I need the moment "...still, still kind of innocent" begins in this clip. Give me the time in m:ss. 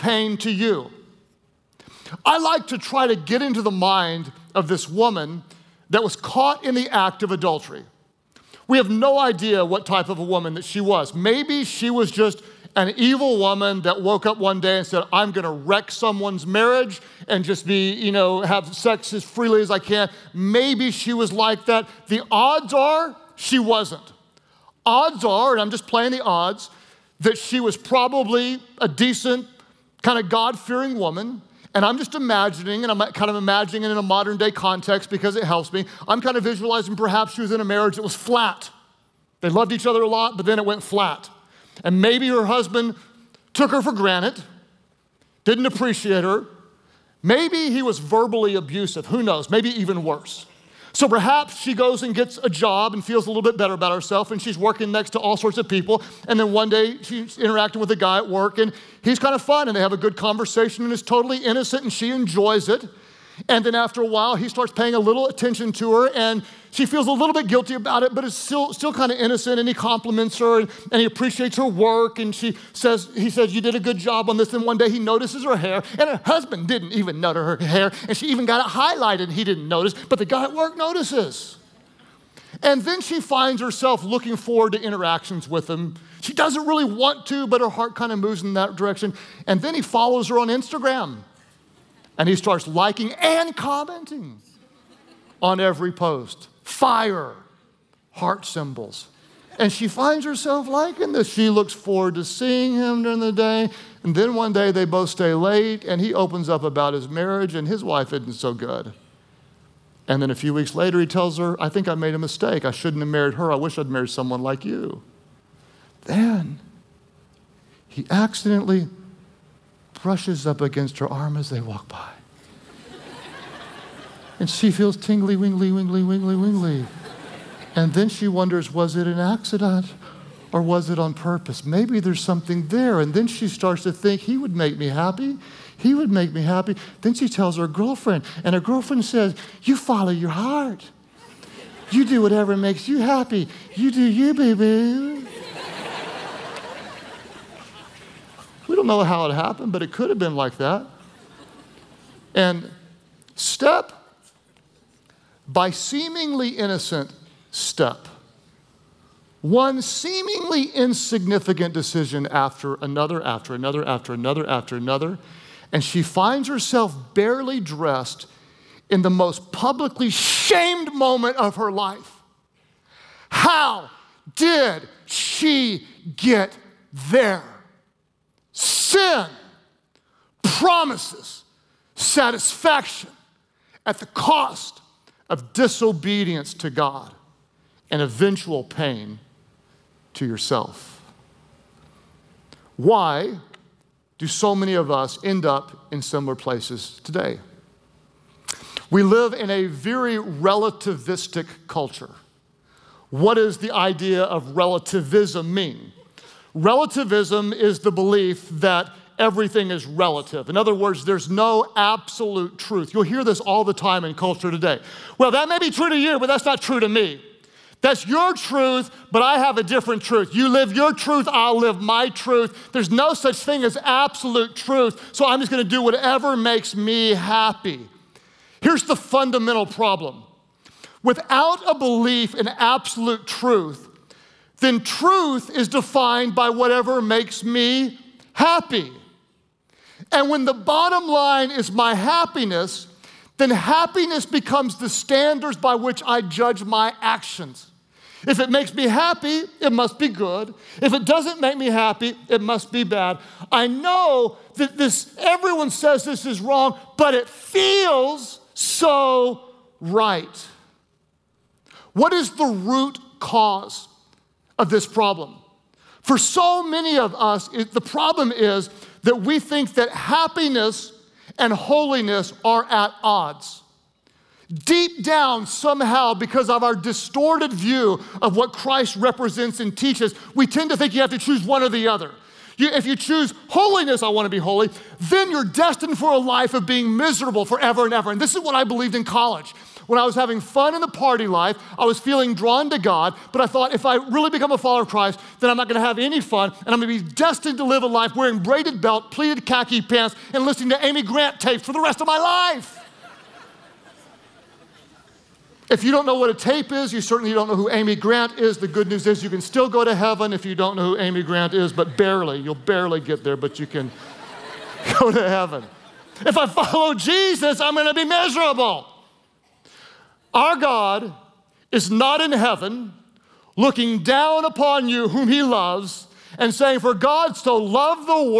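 1:08.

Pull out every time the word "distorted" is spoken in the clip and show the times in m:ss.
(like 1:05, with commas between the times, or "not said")
4:36.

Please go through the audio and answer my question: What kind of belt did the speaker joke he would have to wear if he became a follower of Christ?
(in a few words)
braided belt.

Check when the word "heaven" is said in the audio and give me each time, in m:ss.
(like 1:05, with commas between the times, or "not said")
5:09, 5:15, 5:22.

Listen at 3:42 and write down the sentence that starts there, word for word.
There's no such thing as absolute truth, so I'm just gonna do whatever makes me happy.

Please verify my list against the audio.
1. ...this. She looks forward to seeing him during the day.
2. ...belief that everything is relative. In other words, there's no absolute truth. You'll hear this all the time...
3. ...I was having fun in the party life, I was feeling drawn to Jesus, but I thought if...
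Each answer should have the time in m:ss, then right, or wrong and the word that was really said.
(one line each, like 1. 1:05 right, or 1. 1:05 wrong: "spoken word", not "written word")
1. 1:41 right
2. 3:27 right
3. 4:49 wrong: "God", not "Jesus".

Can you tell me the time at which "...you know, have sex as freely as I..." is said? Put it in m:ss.
0:17.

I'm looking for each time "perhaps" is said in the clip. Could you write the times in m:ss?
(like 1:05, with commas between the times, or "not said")
0:36, 0:51.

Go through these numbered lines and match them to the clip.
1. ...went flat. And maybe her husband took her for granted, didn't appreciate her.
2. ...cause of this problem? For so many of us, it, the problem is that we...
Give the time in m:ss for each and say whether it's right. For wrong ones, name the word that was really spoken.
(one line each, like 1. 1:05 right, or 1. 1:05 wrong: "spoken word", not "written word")
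1. 0:40 right
2. 4:23 right.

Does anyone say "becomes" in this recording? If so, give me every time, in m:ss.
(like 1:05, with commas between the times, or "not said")
4:04, 4:54.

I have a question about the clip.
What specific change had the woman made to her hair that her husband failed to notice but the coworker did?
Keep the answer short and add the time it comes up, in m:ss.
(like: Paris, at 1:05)
highlighted, at 1:18.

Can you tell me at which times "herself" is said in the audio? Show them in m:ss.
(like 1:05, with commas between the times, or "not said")
0:53, 1:23, 1:40, 2:46.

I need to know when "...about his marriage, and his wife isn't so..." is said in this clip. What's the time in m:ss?
1:46.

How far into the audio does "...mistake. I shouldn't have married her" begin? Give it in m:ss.
1:52.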